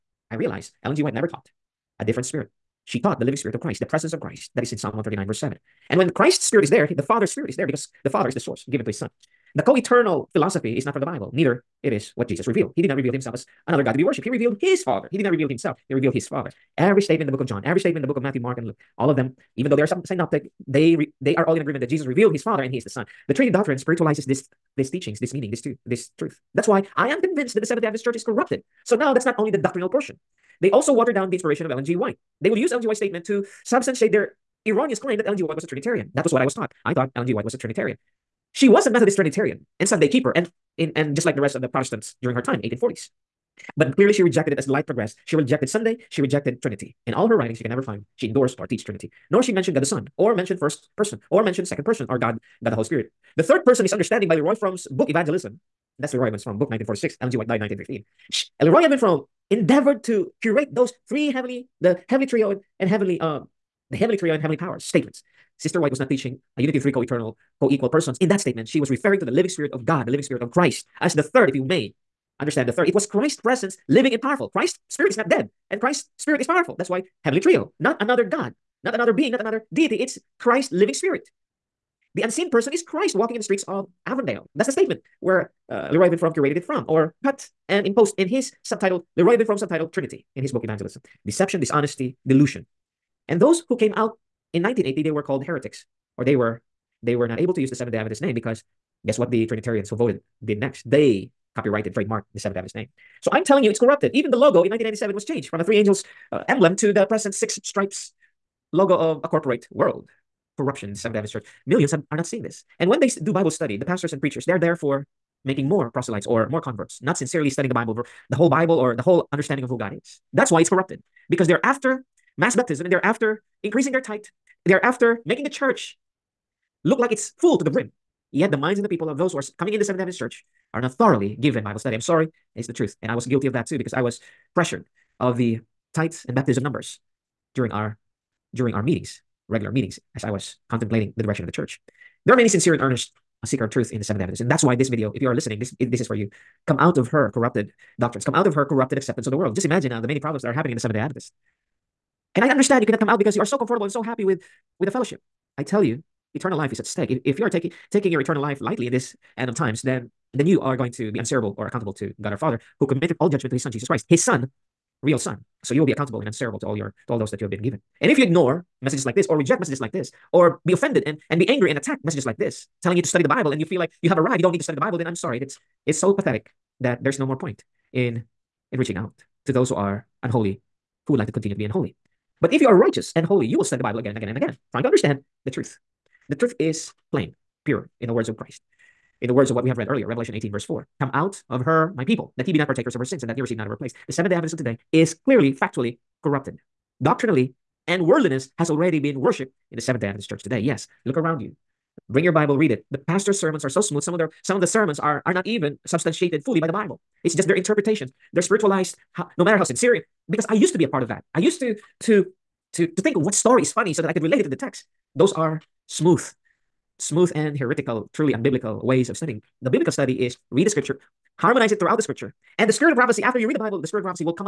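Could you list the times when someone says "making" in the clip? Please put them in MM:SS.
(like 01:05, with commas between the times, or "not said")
01:55, 02:05.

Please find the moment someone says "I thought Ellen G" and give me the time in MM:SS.
00:36.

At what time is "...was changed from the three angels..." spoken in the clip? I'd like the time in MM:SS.
01:45.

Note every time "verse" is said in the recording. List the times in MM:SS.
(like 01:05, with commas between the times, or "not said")
00:05, 03:10.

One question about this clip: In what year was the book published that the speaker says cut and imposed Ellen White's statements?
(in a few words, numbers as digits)
1946.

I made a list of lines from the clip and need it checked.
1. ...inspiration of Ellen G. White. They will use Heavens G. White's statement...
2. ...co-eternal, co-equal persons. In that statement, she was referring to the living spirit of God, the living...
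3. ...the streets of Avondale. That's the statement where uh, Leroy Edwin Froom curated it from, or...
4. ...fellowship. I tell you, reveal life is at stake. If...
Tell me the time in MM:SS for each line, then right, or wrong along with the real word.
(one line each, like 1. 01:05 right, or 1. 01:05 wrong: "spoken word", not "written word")
1. 00:31 wrong: "Ellen", not "Heavens"
2. 01:06 right
3. 01:23 right
4. 02:34 wrong: "eternal", not "reveal".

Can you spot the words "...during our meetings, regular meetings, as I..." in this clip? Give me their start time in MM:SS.
02:18.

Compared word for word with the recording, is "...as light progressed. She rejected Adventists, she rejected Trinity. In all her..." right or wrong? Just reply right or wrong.
wrong.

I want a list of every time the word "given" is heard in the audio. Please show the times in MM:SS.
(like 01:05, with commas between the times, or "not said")
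00:08, 02:11, 02:47.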